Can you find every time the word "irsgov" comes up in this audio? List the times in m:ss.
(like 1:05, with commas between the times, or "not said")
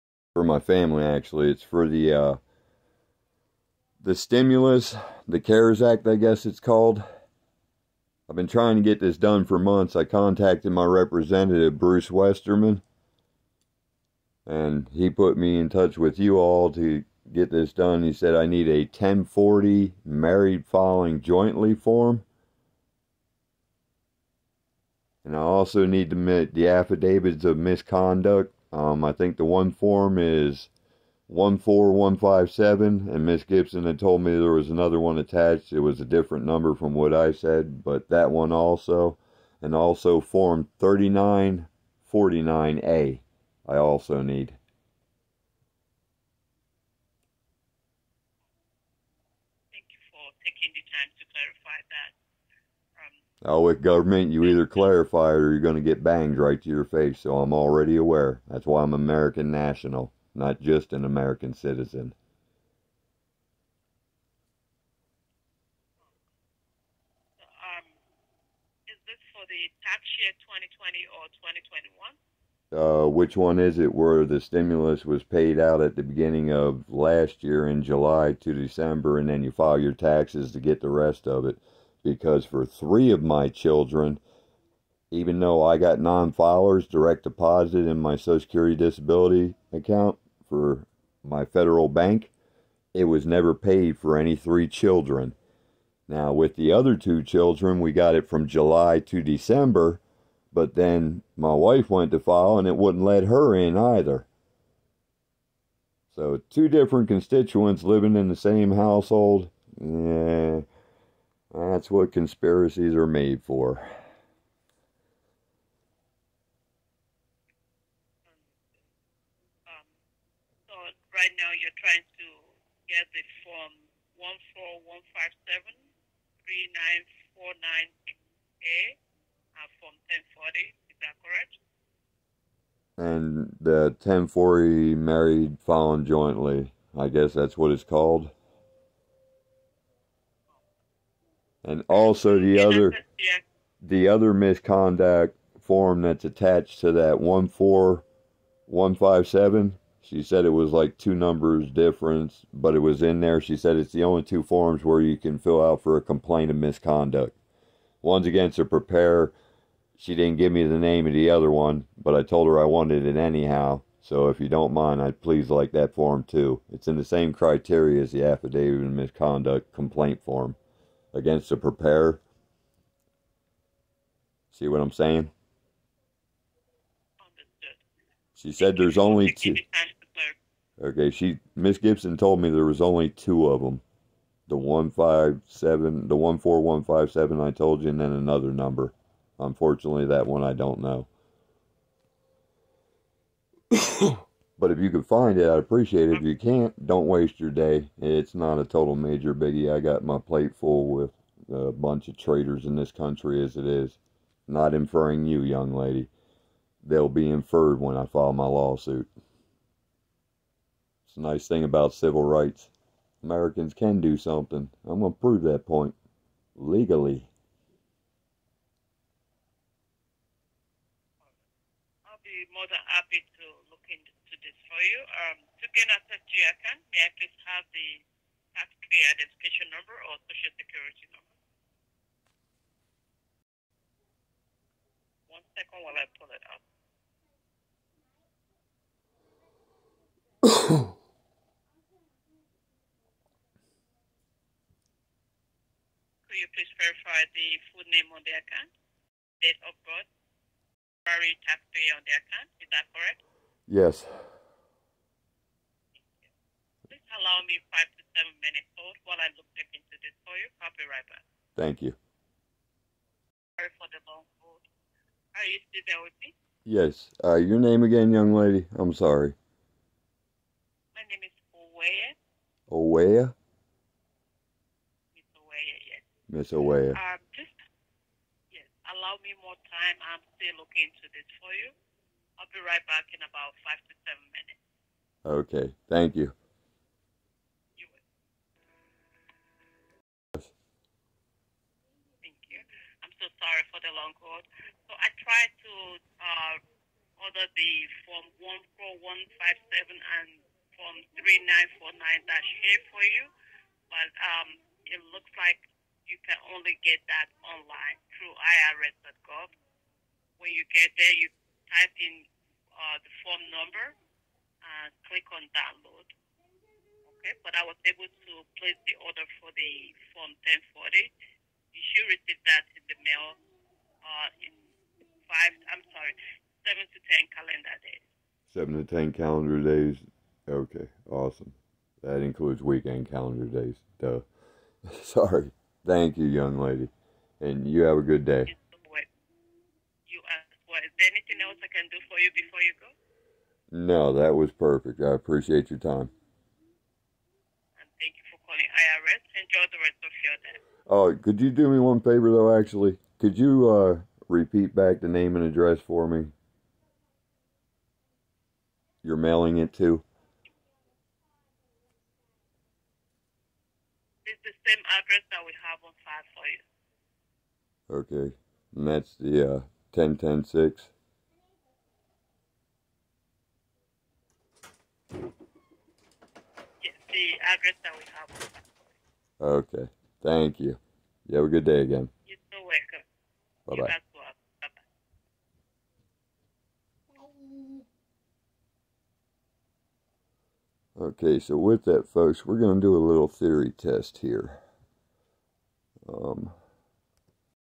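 5:08.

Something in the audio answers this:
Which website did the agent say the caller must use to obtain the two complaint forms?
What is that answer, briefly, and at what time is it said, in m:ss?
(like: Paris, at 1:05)
irs.gov, at 5:08.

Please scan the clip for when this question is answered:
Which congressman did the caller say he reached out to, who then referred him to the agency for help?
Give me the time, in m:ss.
0:11.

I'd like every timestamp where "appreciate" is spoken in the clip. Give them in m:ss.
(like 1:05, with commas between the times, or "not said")
3:15, 5:45.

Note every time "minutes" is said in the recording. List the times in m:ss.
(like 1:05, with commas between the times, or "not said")
4:18, 4:44.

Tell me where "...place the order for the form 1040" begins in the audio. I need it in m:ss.
5:18.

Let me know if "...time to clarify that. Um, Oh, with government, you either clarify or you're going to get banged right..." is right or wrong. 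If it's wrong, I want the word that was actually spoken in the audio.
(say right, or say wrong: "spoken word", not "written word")
right.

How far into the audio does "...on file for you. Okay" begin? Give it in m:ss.
6:07.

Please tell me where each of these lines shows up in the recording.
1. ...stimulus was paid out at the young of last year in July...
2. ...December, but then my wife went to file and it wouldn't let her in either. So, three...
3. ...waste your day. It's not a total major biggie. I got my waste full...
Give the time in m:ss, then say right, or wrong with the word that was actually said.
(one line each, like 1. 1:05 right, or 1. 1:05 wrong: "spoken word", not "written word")
1. 1:14 wrong: "beginning", not "young"
2. 1:39 wrong: "two", not "three"
3. 3:17 wrong: "plate", not "waste".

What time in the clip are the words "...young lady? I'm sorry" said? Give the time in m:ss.
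4:28.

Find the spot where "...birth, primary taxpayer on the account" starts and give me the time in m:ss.
4:09.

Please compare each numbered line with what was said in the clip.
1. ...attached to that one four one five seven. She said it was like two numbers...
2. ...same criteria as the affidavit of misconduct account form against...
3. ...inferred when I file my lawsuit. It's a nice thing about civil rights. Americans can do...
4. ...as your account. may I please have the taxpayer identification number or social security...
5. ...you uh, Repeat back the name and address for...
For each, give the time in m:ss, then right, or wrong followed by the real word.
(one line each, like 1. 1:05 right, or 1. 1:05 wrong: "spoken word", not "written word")
1. 2:26 right
2. 2:47 wrong: "complaint", not "account"
3. 3:27 right
4. 3:45 right
5. 5:53 right.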